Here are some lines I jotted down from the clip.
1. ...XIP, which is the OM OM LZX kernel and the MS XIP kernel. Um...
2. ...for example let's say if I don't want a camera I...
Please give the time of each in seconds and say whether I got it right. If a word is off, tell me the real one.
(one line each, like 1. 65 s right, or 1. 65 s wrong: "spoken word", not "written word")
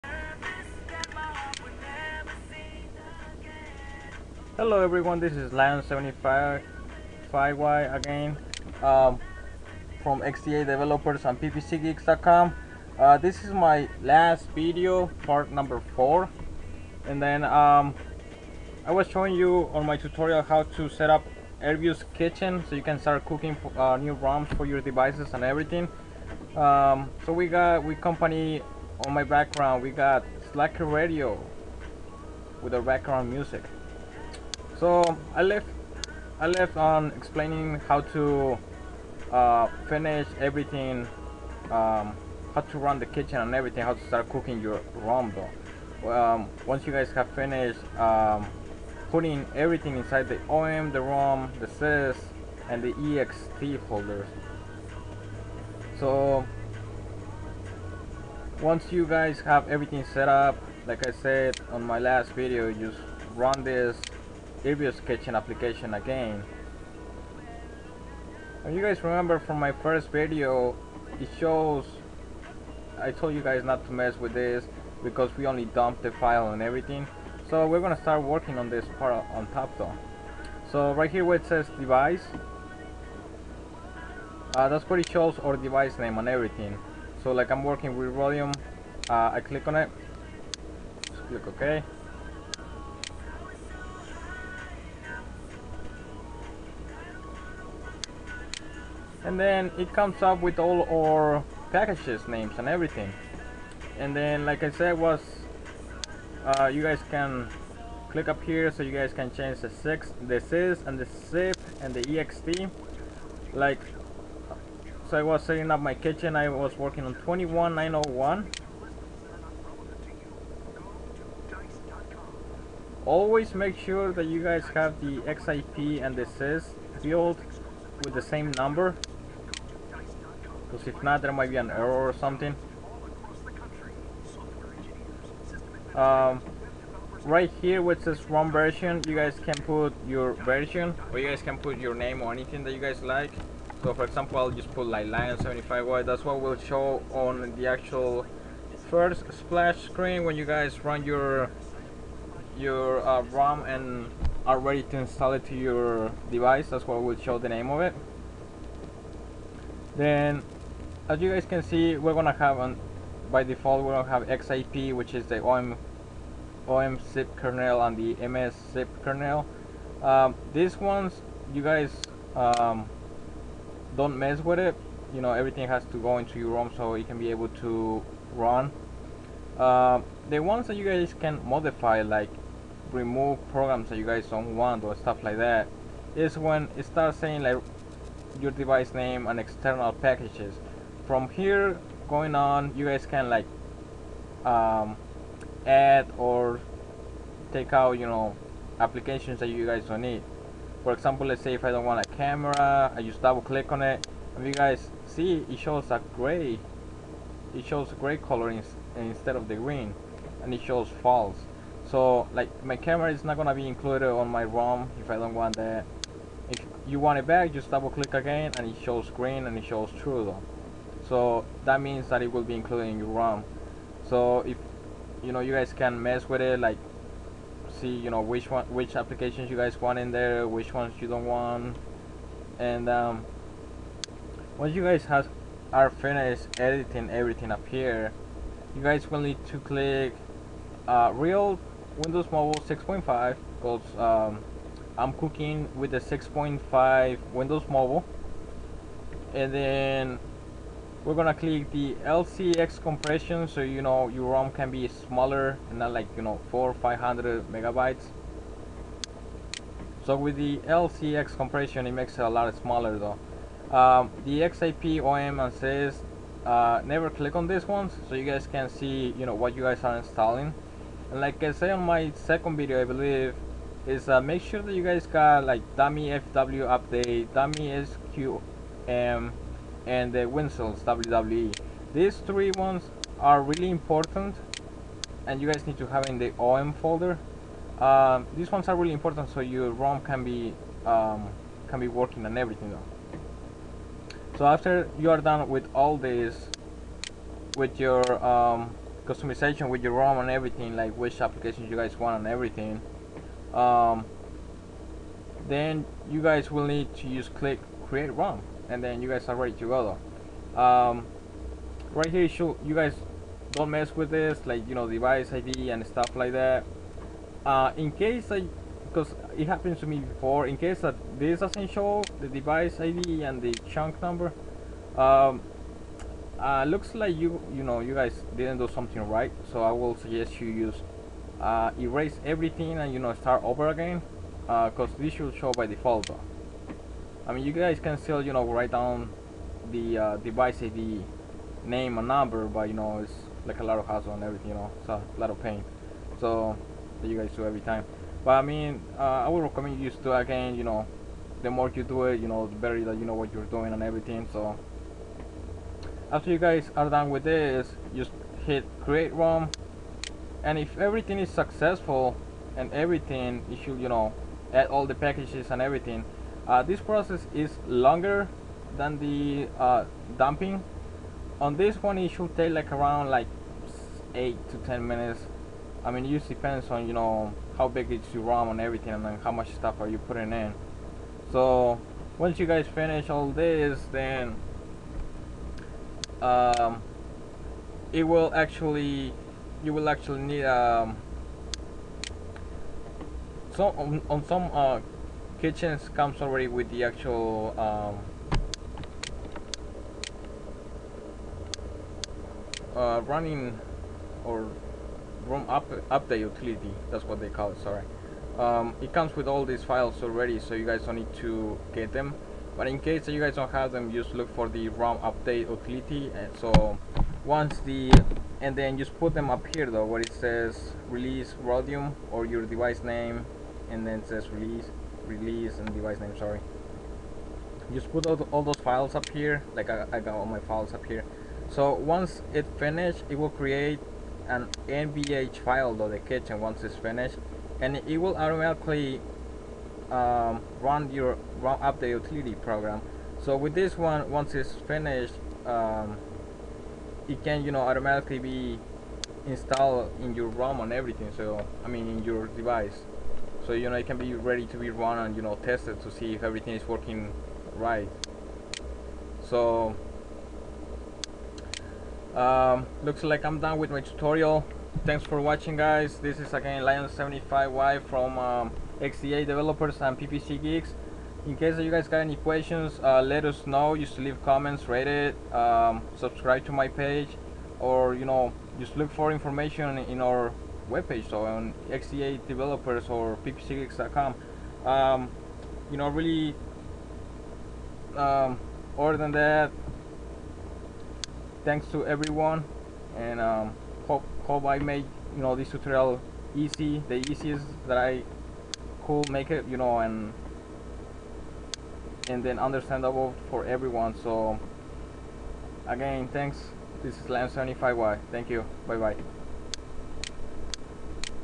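1. 164 s wrong: "XIP", not "LZX"
2. 200 s right.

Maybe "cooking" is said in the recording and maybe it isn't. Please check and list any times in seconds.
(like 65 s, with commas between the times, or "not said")
23 s, 44 s, 245 s.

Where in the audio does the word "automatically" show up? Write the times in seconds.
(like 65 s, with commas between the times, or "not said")
438 s, 447 s.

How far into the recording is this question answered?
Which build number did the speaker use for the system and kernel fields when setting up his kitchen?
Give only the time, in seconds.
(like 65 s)
117 s.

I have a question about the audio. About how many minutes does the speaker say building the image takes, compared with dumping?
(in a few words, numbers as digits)
8 to 10 minutes.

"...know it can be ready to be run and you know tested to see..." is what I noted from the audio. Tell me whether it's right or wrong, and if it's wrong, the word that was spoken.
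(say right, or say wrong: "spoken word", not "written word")
right.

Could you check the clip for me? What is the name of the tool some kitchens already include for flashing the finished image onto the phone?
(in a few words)
ROM Update Utility.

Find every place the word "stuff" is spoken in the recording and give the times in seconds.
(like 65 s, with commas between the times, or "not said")
184 s, 315 s, 379 s.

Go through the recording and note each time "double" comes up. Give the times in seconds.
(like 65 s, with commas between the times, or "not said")
203 s, 217 s.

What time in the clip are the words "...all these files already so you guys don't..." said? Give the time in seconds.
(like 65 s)
409 s.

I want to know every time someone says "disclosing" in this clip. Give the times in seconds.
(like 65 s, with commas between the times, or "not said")
not said.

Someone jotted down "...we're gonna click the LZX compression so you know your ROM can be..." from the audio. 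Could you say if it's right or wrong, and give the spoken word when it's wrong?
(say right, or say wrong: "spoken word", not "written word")
right.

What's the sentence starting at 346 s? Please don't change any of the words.
So that you guys do every time.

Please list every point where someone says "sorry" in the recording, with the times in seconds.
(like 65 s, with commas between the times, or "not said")
407 s, 426 s.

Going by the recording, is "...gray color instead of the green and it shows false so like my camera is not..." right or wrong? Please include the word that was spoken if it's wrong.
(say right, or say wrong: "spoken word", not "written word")
right.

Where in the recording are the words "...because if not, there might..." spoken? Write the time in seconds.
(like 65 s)
130 s.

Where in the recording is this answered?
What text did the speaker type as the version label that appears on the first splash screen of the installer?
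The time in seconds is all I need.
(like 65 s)
145 s.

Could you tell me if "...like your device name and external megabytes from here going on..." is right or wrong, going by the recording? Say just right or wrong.
wrong.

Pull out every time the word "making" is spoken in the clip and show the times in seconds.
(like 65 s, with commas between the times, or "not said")
not said.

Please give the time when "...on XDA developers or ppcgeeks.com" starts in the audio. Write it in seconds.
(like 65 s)
481 s.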